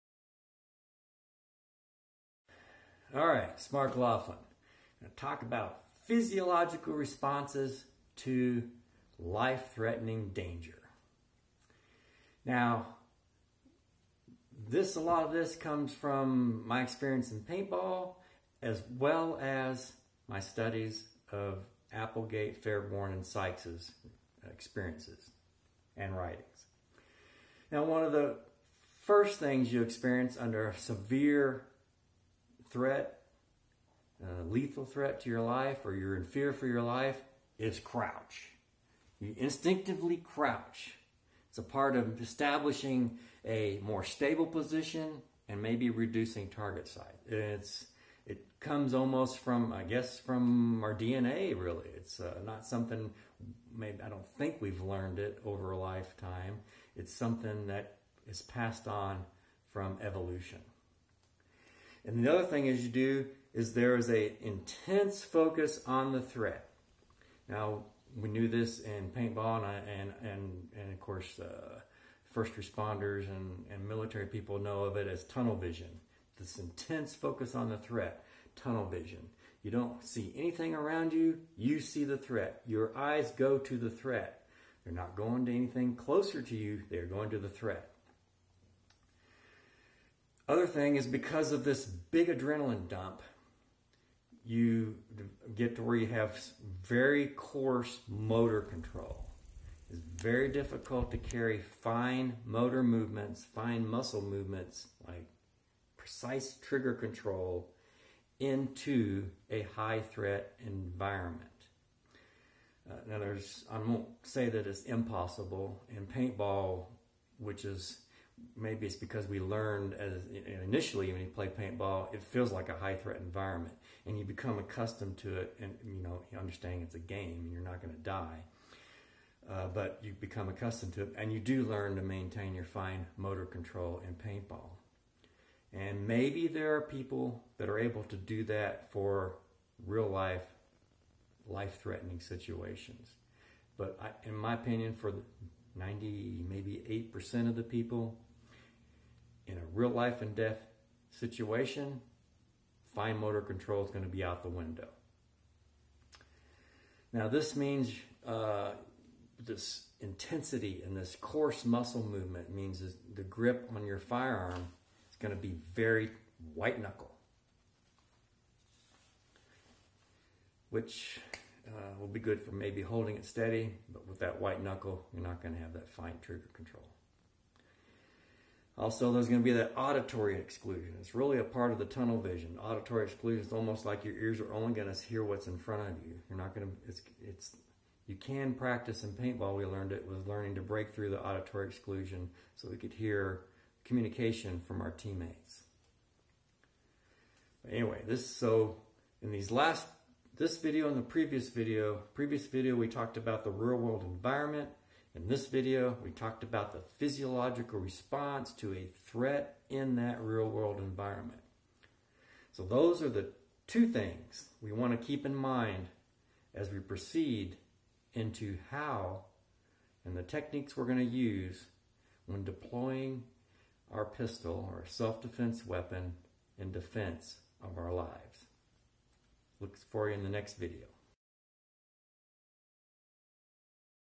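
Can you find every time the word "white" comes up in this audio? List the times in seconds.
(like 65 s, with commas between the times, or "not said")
166 s, 174 s.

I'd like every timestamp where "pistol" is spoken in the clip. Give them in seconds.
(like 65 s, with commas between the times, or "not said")
224 s.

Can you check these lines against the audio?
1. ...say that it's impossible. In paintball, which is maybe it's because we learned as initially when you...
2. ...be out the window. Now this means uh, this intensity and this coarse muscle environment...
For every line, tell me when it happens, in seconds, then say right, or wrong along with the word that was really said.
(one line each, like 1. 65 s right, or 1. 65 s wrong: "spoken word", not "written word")
1. 114 s right
2. 154 s wrong: "movement", not "environment".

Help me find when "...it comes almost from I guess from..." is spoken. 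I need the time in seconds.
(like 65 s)
48 s.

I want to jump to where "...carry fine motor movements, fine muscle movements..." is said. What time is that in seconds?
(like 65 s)
101 s.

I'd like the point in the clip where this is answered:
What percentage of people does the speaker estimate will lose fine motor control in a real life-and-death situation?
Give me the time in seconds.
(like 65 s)
145 s.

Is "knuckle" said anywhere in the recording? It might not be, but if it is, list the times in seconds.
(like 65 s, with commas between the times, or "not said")
166 s, 174 s.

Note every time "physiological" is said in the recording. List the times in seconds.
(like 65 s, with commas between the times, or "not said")
6 s, 206 s.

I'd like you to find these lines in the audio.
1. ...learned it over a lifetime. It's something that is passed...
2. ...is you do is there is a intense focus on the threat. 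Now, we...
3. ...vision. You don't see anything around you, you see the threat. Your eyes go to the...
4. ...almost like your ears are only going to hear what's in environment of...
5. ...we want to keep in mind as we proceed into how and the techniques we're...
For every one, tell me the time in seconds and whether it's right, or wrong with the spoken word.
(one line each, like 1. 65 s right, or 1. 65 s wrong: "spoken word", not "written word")
1. 54 s right
2. 62 s right
3. 78 s right
4. 183 s wrong: "front", not "environment"
5. 214 s right.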